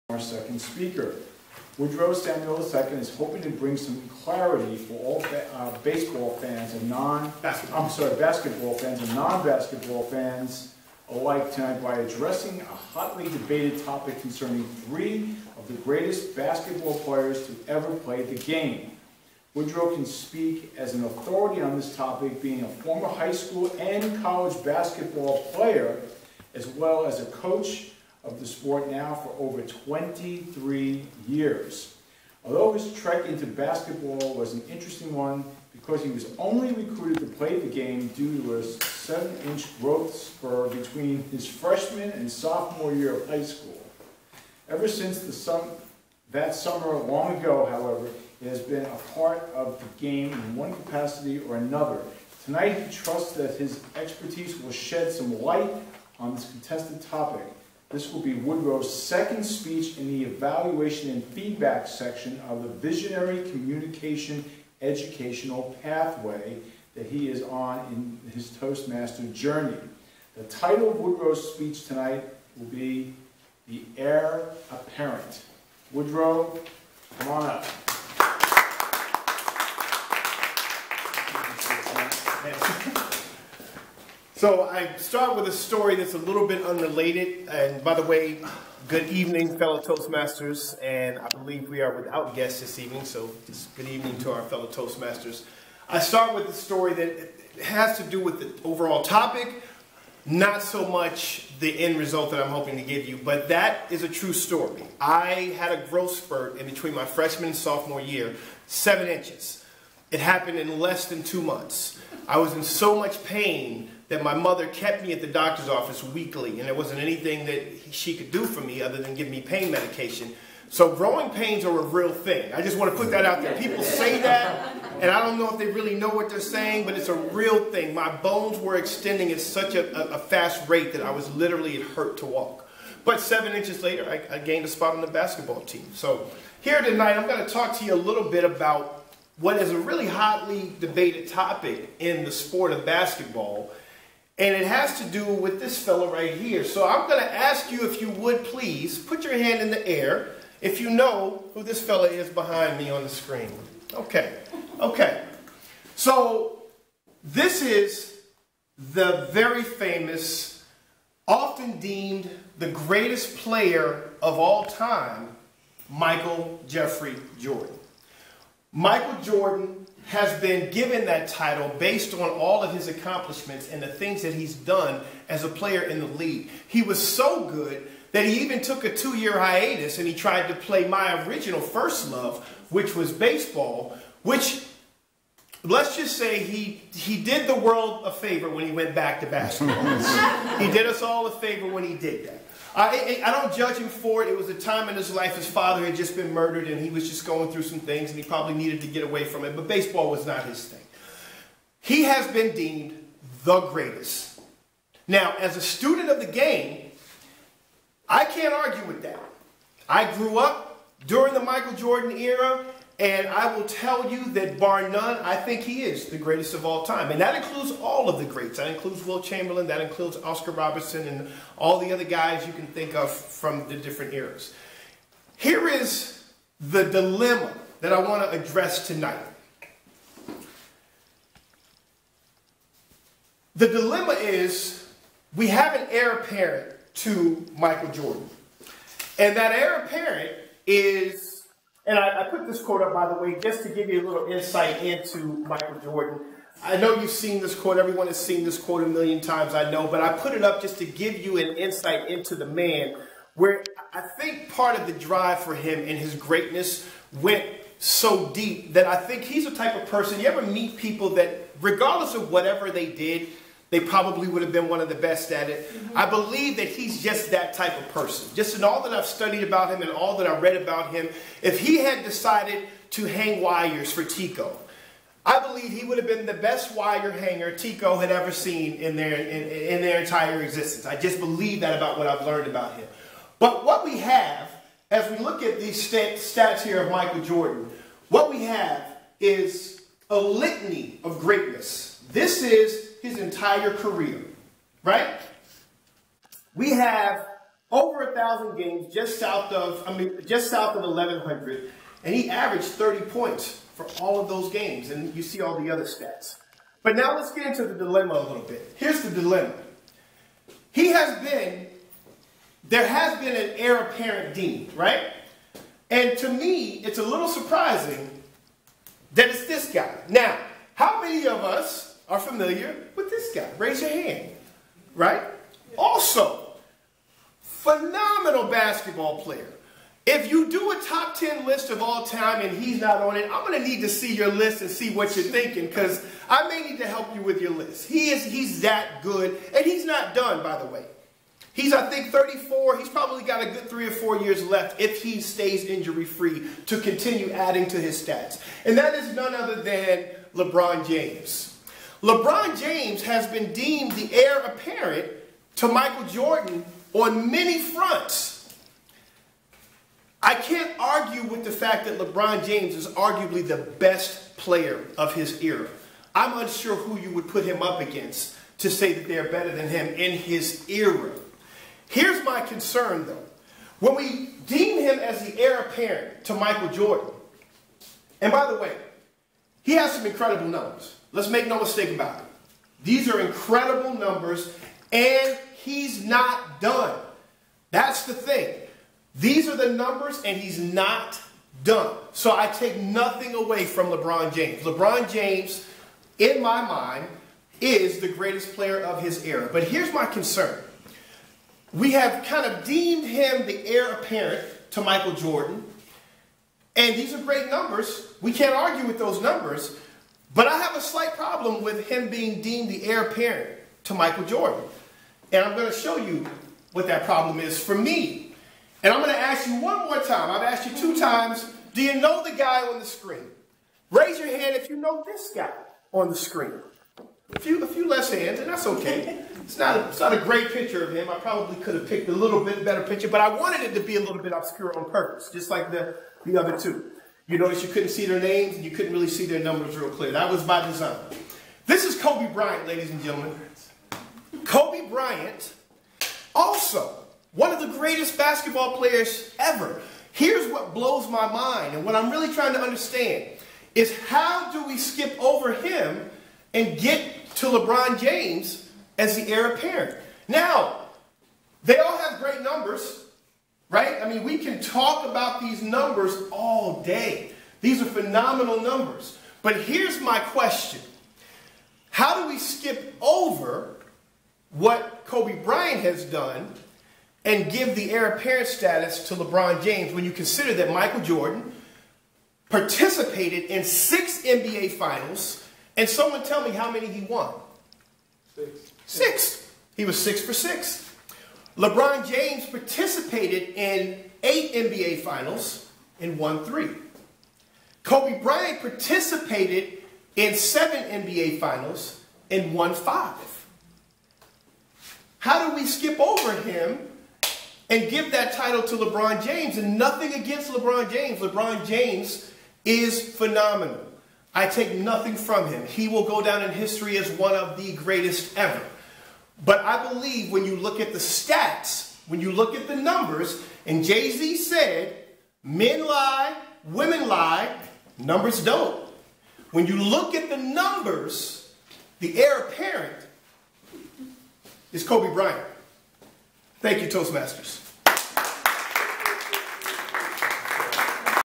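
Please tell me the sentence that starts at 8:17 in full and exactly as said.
Kobe Bryant participated in seven NBA finals and won five.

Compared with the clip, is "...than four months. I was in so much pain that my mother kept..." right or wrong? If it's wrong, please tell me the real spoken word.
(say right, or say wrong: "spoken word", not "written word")
wrong: "two", not "four".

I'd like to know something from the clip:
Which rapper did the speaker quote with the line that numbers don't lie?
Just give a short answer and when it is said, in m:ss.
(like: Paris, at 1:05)
Jay Z, at 8:43.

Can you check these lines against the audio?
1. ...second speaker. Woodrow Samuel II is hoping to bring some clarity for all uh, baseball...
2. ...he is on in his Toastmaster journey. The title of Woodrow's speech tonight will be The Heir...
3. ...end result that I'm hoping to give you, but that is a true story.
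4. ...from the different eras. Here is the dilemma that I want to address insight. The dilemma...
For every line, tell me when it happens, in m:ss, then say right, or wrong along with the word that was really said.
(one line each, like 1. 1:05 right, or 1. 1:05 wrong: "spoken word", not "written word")
1. 0:00 right
2. 1:07 right
3. 1:41 right
4. 3:43 wrong: "tonight", not "insight".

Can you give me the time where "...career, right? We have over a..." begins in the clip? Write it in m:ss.
4:53.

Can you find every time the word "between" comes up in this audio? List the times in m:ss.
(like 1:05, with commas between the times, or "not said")
0:40, 1:46.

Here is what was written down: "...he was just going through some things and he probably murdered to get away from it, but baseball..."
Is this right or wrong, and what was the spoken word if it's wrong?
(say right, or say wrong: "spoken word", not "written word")
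wrong: "needed", not "murdered".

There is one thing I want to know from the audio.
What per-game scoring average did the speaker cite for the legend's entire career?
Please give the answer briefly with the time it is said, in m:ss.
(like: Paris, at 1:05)
30 points, at 5:02.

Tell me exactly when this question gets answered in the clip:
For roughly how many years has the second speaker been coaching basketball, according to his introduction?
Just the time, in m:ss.
0:29.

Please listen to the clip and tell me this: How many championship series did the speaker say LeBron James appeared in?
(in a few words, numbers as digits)
8.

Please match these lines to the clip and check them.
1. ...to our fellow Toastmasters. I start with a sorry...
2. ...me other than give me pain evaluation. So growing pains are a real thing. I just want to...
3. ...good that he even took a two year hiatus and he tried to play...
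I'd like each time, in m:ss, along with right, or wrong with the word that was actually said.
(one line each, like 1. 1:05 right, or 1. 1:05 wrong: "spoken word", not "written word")
1. 1:34 wrong: "story", not "sorry"
2. 1:58 wrong: "medication", not "evaluation"
3. 2:57 right.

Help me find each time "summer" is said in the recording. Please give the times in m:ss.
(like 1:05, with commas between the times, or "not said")
0:46.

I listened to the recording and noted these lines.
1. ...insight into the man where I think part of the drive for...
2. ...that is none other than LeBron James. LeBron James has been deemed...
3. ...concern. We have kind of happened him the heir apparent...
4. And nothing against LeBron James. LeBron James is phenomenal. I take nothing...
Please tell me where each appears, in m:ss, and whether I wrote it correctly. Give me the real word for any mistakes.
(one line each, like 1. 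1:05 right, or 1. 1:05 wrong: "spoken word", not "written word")
1. 4:11 right
2. 5:48 right
3. 6:40 wrong: "deemed", not "happened"
4. 8:29 right.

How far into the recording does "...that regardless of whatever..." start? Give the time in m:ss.
4:21.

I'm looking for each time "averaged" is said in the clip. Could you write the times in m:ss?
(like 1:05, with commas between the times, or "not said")
5:02.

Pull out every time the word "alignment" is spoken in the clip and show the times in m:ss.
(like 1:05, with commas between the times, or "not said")
not said.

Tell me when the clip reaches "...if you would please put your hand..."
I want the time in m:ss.
2:27.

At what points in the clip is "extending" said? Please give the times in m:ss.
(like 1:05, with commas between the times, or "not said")
2:08.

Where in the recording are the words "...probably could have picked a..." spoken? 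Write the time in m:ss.
7:11.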